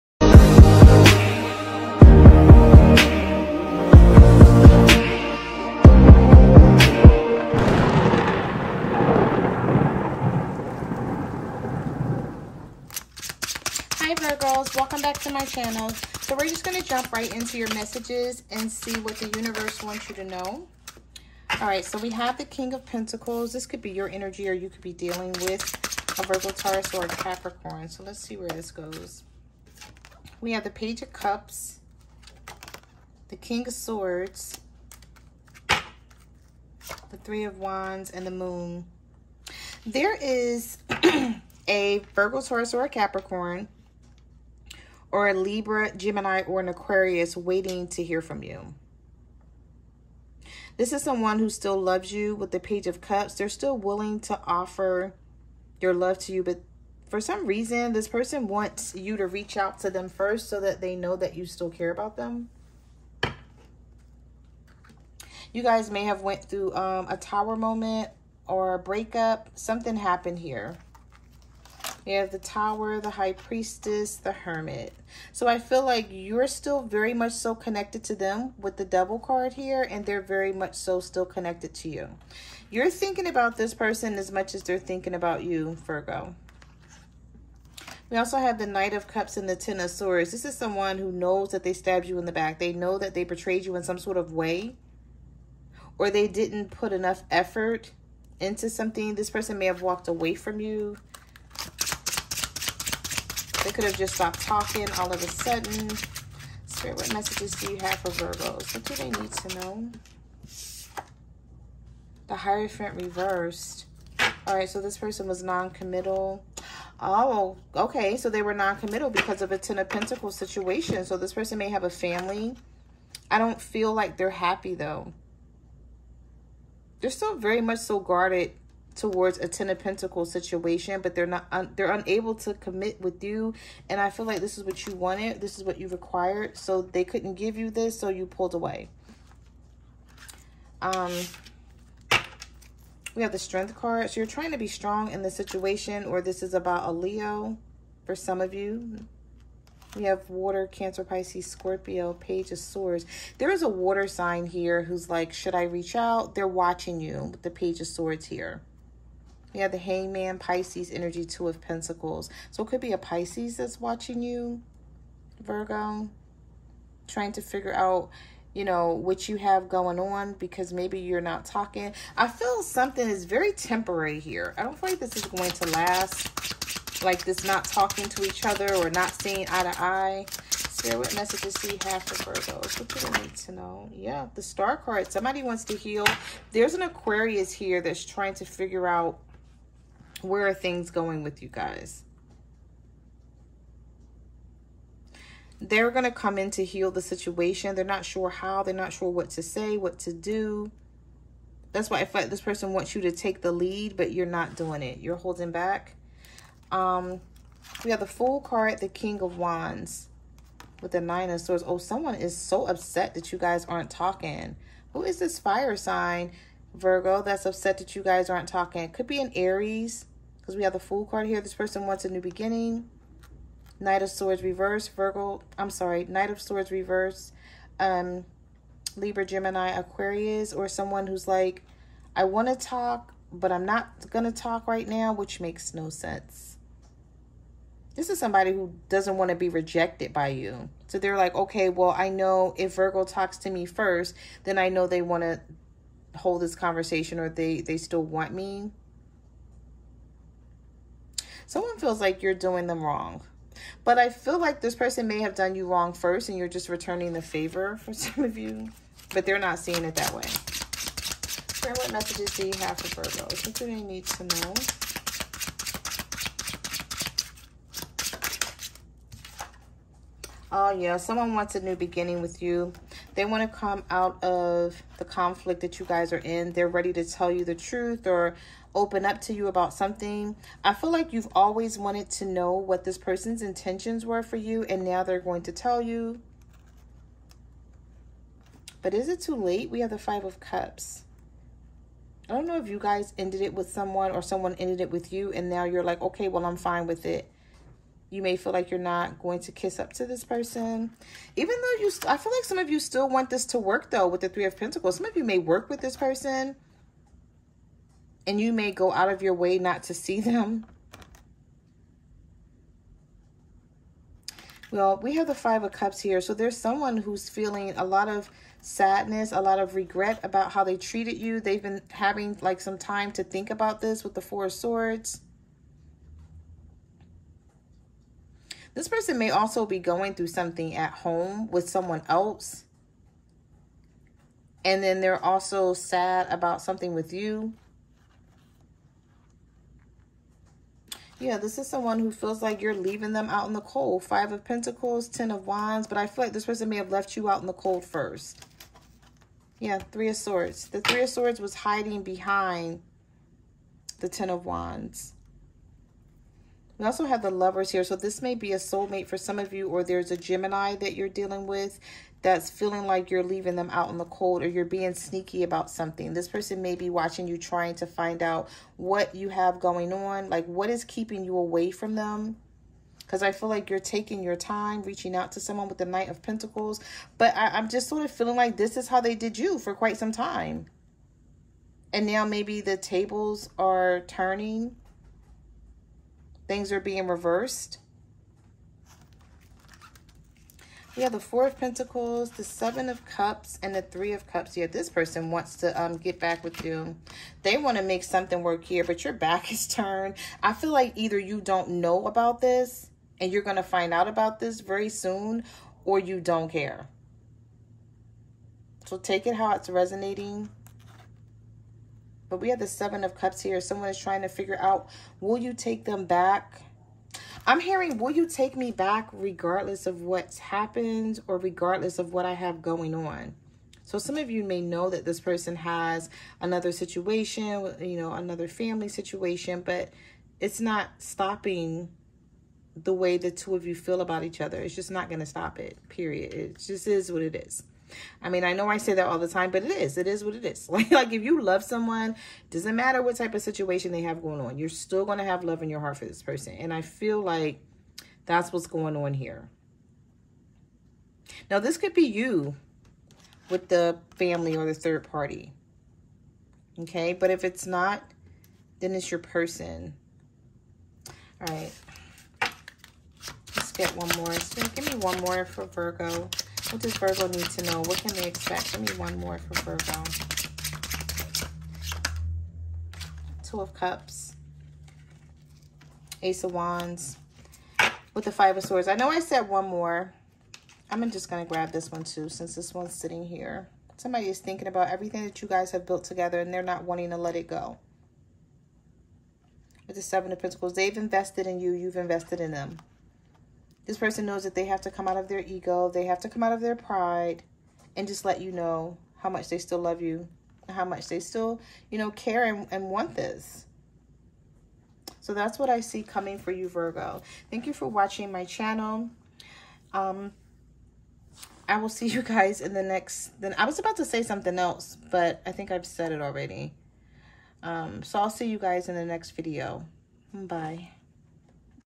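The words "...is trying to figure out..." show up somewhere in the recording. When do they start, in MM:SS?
06:53.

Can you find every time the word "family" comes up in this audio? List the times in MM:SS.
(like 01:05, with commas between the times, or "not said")
02:01, 07:08, 07:34.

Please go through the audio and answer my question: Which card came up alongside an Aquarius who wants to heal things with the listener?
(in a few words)
The Star.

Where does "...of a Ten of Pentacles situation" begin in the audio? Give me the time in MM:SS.
01:59.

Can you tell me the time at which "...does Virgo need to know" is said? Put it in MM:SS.
07:46.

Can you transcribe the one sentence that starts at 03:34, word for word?
Who is this fire sign, Virgo, that's upset that you guys aren't talking?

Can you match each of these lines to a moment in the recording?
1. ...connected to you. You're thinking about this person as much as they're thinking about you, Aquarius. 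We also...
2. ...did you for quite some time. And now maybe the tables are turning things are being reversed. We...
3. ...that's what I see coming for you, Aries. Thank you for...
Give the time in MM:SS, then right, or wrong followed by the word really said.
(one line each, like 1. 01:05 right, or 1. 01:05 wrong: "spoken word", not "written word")
1. 01:21 wrong: "Virgo", not "Aquarius"
2. 06:19 right
3. 08:25 wrong: "Virgo", not "Aries".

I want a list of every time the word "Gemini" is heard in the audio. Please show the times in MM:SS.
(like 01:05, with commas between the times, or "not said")
00:45, 03:49, 06:00.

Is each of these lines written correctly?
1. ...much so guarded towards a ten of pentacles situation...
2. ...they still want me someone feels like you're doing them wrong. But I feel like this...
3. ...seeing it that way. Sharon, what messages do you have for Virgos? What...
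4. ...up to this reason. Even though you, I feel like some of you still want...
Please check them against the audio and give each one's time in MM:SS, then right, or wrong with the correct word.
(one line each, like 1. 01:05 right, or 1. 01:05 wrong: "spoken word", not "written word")
1. 02:07 right
2. 04:07 right
3. 04:19 right
4. 04:59 wrong: "person", not "reason".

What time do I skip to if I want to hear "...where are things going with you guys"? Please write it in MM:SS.
03:10.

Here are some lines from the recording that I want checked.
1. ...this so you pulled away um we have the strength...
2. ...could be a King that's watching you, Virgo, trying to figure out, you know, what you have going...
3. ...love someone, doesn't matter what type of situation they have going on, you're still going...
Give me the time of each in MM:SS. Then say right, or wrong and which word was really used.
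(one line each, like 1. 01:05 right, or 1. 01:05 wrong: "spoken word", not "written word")
1. 02:17 right
2. 02:42 wrong: "Pisces", not "King"
3. 07:21 right.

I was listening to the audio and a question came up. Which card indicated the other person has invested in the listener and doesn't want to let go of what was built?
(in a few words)
Seven of Pentacles.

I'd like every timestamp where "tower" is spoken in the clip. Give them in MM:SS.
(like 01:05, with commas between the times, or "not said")
01:07, 01:12.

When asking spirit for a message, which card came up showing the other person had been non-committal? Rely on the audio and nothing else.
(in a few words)
The Hierophant reversed.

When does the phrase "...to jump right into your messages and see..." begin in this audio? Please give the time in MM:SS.
00:16.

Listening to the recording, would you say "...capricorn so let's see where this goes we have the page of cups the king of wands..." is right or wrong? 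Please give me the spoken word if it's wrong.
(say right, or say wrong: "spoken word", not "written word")
wrong: "swords", not "wands".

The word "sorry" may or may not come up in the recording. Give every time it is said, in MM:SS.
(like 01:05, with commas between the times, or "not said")
03:45.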